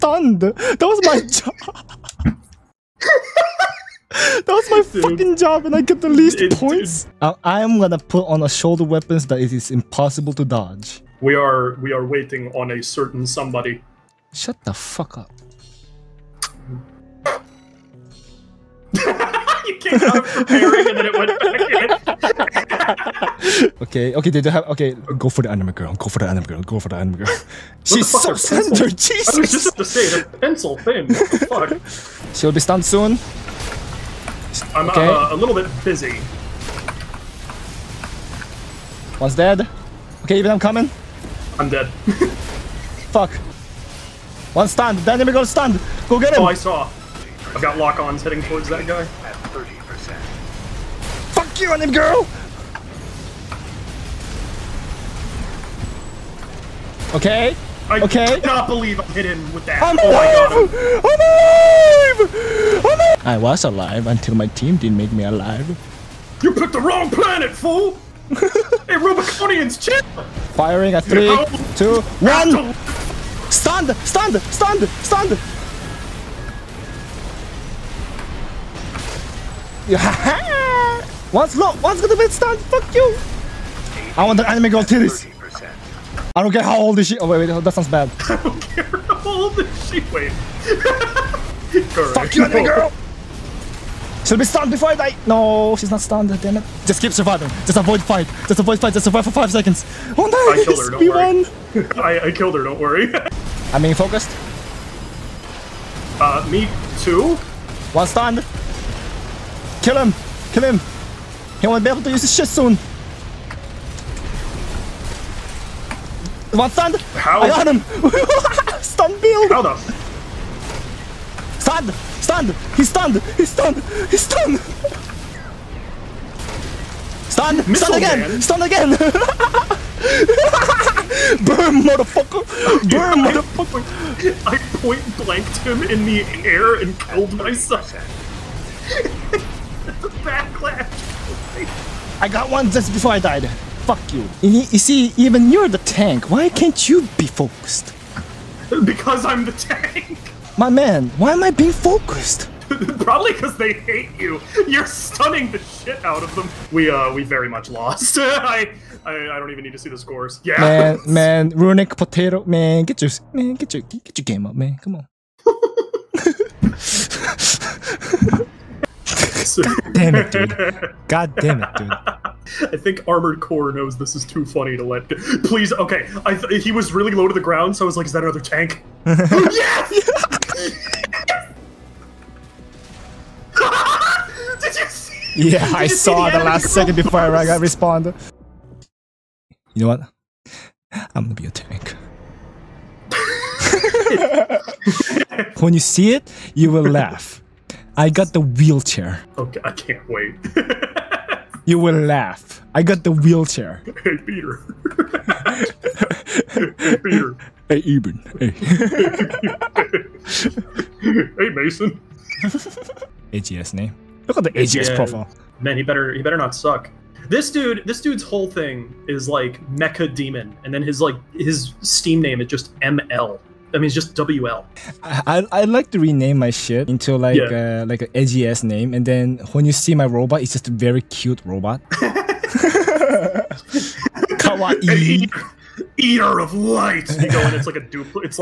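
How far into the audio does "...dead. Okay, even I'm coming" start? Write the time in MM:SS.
00:39.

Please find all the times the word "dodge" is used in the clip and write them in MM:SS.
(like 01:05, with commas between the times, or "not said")
00:10.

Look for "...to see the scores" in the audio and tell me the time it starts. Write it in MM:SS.
02:39.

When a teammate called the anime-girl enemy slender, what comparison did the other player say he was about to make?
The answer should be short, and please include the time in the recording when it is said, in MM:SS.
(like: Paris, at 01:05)
the pencil thing, at 00:30.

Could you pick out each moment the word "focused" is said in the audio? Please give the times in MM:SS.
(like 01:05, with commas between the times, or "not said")
01:43, 02:27, 02:31.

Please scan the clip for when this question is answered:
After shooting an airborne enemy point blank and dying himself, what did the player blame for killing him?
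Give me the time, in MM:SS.
02:20.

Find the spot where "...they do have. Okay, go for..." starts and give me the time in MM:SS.
00:24.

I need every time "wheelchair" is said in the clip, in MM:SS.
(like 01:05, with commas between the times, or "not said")
03:18, 03:23.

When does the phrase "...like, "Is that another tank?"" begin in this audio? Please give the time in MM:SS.
02:57.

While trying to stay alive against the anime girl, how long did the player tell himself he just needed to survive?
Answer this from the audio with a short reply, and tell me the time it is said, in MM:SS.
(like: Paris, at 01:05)
5 seconds, at 01:39.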